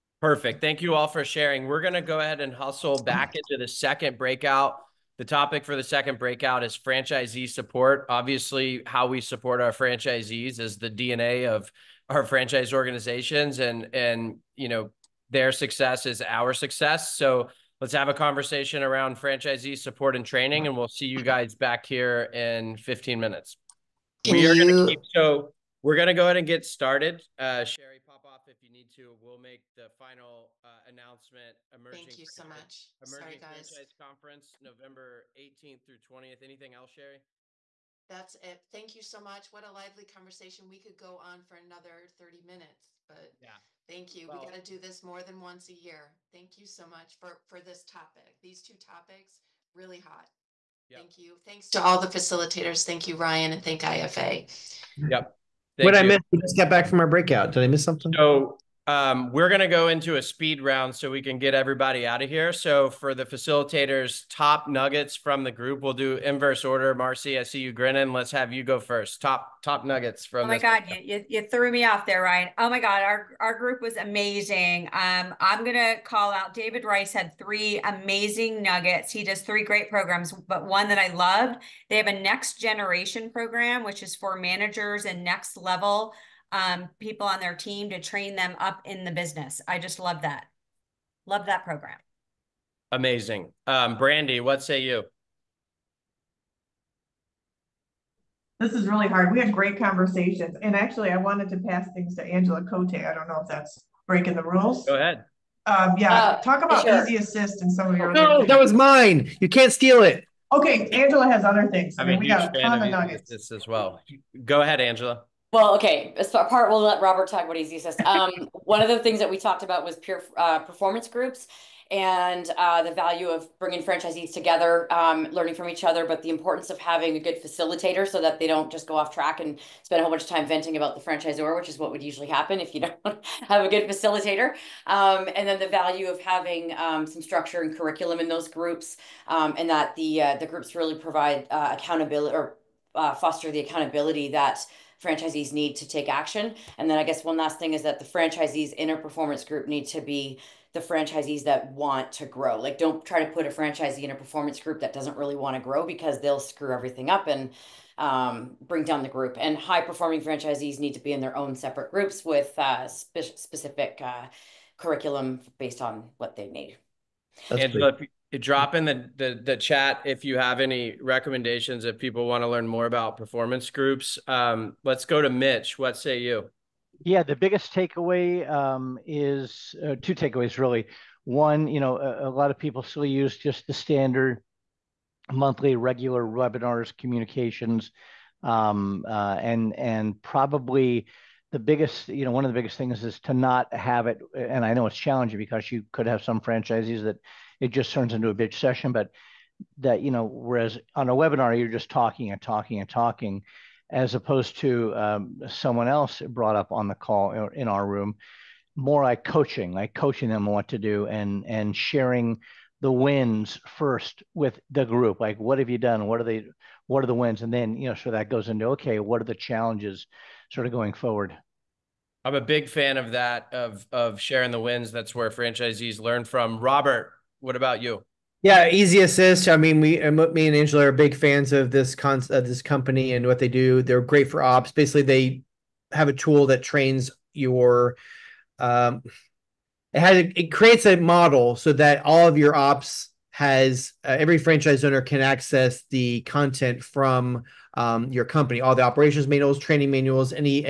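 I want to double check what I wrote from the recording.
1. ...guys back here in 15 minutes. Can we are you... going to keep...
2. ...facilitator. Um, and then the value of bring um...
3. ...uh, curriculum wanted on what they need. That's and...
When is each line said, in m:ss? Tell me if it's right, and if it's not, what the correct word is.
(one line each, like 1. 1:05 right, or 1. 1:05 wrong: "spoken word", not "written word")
1. 0:21 right
2. 2:13 wrong: "having", not "bring"
3. 2:44 wrong: "based", not "wanted".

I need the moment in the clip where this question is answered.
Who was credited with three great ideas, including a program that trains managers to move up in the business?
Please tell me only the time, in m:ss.
1:16.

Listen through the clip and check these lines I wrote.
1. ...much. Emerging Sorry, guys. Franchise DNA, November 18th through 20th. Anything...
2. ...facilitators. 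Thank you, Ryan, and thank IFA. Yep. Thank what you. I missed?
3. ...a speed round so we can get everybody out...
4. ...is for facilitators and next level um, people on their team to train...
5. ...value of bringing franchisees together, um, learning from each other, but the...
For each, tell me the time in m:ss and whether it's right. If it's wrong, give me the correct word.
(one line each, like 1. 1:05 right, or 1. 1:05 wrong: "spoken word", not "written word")
1. 0:32 wrong: "Conference", not "DNA"
2. 0:52 right
3. 1:00 right
4. 1:24 wrong: "managers", not "facilitators"
5. 2:02 right.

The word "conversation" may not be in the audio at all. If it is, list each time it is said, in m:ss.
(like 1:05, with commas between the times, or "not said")
0:18, 0:40, 1:39.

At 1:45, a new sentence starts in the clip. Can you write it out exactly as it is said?
Um, yeah, uh, talk about sure.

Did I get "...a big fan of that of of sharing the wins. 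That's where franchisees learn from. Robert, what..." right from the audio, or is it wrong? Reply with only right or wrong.
right.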